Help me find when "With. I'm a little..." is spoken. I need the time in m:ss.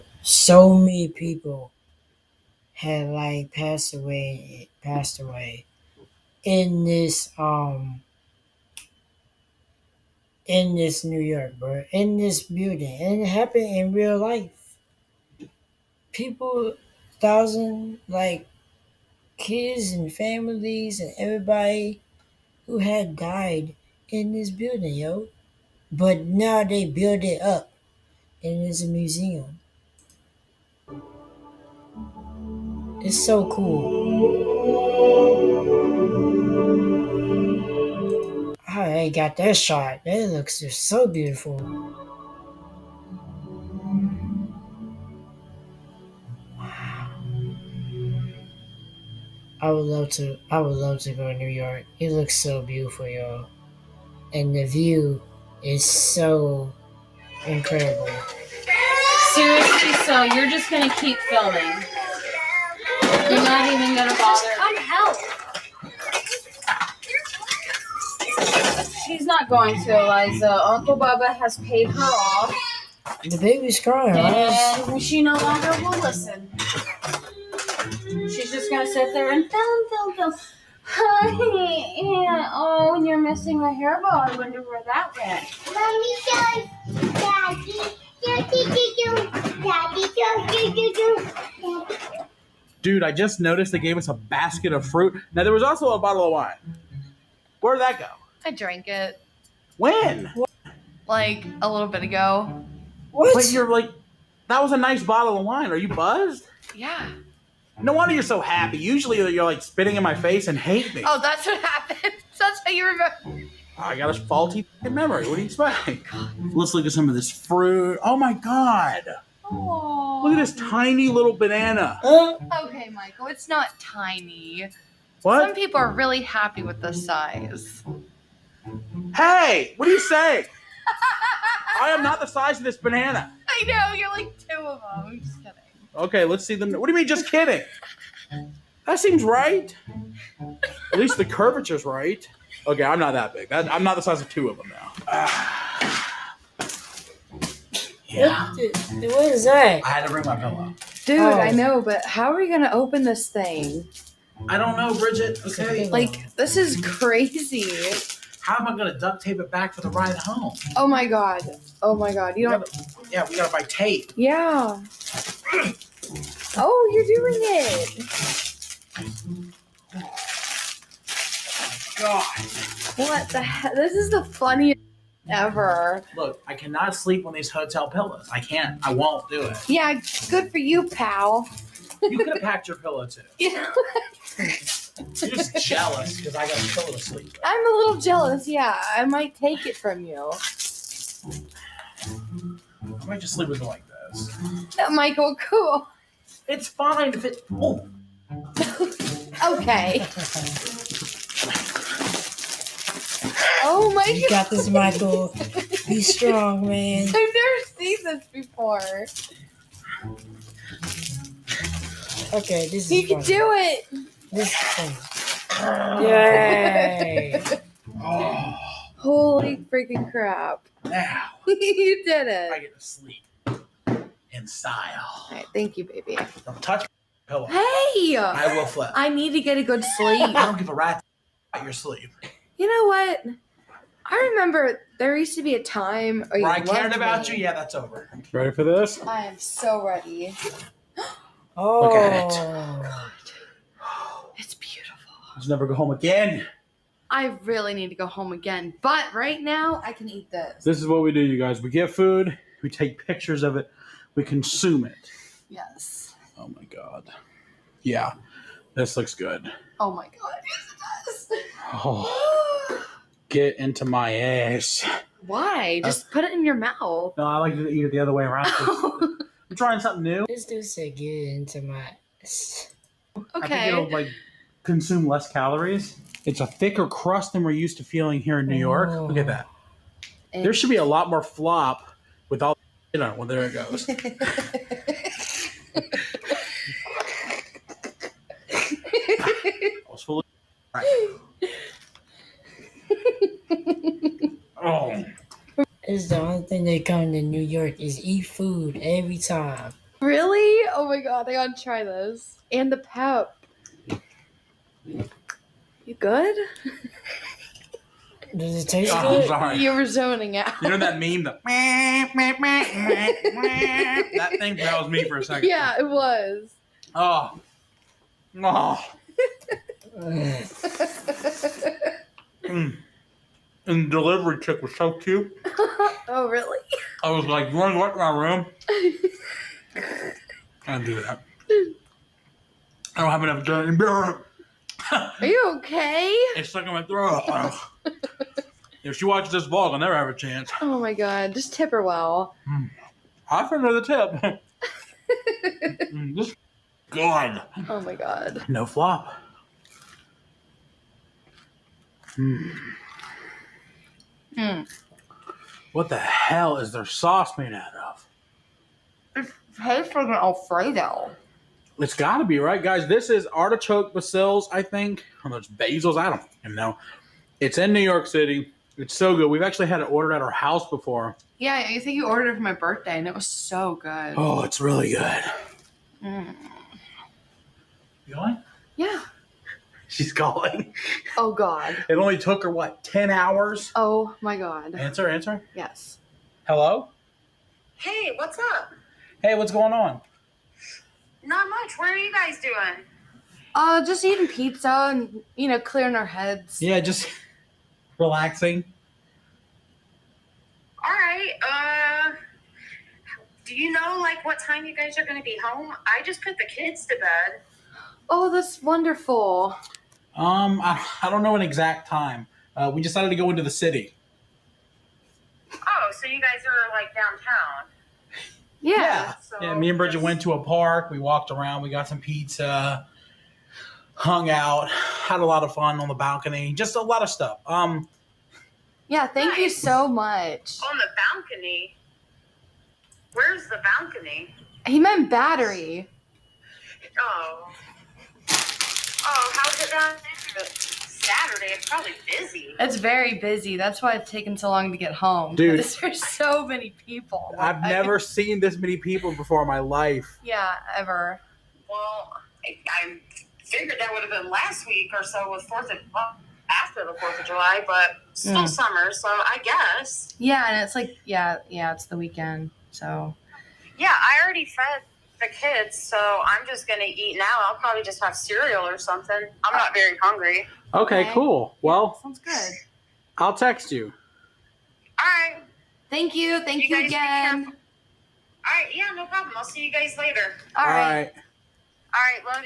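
3:07.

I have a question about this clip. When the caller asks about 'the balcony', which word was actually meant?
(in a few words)
battery.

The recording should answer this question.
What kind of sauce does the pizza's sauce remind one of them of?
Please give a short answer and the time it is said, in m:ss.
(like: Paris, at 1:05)
Alfredo, at 6:00.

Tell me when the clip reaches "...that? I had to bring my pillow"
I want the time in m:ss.
2:29.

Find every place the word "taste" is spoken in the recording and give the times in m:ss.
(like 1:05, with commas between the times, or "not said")
5:08, 5:59.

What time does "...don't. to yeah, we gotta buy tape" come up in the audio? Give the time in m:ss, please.
2:42.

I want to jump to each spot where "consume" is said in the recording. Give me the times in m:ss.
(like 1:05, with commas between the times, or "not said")
4:14, 4:34.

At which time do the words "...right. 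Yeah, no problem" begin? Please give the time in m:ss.
7:58.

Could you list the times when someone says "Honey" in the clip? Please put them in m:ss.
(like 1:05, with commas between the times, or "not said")
1:20.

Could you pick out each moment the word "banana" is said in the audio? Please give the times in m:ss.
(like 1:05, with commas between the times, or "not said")
2:01, 2:12.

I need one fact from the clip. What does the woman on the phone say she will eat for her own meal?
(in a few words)
cereal.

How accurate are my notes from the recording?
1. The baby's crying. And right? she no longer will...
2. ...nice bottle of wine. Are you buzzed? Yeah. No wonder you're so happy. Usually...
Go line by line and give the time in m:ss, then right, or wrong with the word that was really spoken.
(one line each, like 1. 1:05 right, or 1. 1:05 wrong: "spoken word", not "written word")
1. 1:13 right
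2. 1:44 right.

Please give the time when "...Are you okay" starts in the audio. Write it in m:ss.
5:35.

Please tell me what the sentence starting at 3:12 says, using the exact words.
I might just sleep with it like does.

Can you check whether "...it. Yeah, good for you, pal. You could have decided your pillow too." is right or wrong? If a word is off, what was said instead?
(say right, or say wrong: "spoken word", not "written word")
wrong: "packed", not "decided".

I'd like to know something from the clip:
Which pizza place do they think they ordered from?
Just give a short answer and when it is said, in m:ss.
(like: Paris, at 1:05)
Artichoke Basille's, at 6:03.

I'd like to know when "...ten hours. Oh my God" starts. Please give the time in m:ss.
6:22.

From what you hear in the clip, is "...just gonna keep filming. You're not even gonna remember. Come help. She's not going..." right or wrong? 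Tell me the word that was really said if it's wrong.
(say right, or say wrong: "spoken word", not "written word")
wrong: "bother", not "remember".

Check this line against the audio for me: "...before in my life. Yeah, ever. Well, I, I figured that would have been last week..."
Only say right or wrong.
right.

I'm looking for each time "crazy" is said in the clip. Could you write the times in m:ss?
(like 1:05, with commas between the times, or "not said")
2:36.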